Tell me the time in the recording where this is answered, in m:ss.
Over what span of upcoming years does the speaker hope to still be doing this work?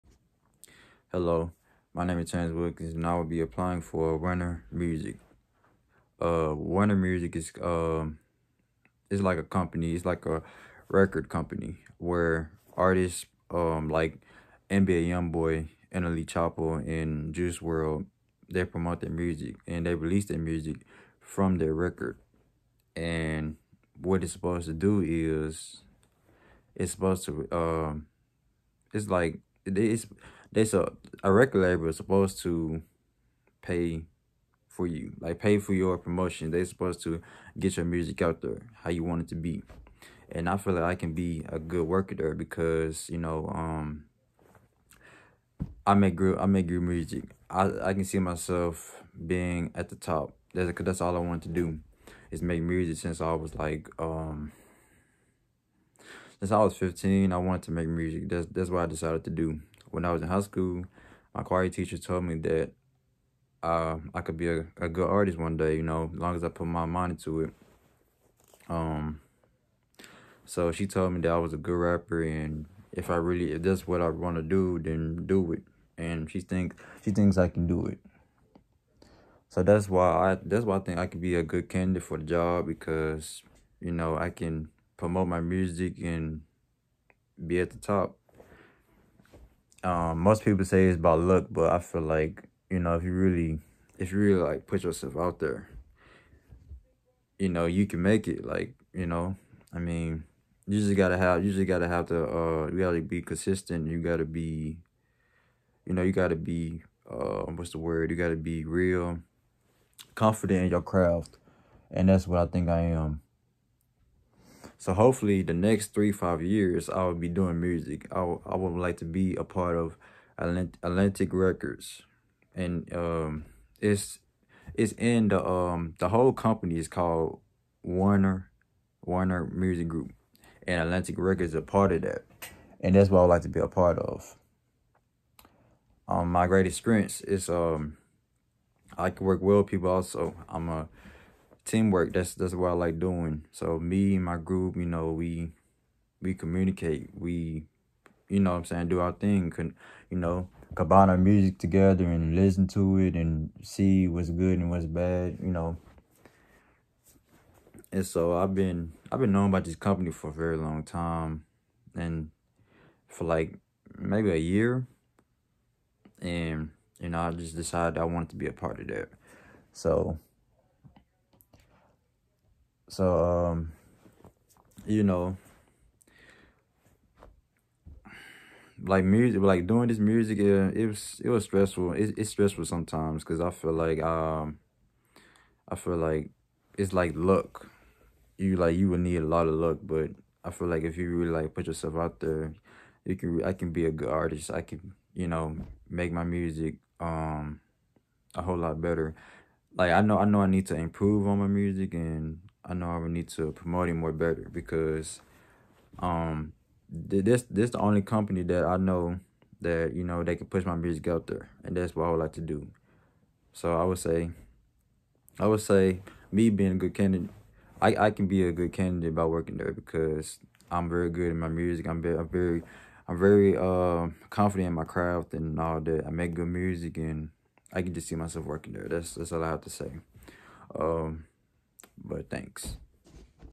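1:55.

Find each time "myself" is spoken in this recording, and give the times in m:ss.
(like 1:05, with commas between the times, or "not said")
0:48, 3:48.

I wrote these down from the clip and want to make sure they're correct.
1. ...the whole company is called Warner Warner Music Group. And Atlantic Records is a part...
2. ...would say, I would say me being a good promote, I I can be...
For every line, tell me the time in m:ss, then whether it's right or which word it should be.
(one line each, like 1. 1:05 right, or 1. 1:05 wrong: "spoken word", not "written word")
1. 2:05 right
2. 3:33 wrong: "candidate", not "promote".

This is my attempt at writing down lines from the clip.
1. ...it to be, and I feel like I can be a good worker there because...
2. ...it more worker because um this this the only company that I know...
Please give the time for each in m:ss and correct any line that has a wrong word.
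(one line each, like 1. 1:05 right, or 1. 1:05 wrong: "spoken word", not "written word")
1. 0:39 right
2. 3:23 wrong: "better", not "worker".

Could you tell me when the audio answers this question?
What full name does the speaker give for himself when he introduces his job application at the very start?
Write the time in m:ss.
0:02.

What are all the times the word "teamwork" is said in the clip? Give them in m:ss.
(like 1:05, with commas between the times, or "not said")
2:21.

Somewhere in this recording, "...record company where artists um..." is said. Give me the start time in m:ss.
0:10.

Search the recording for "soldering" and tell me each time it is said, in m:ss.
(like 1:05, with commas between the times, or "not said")
not said.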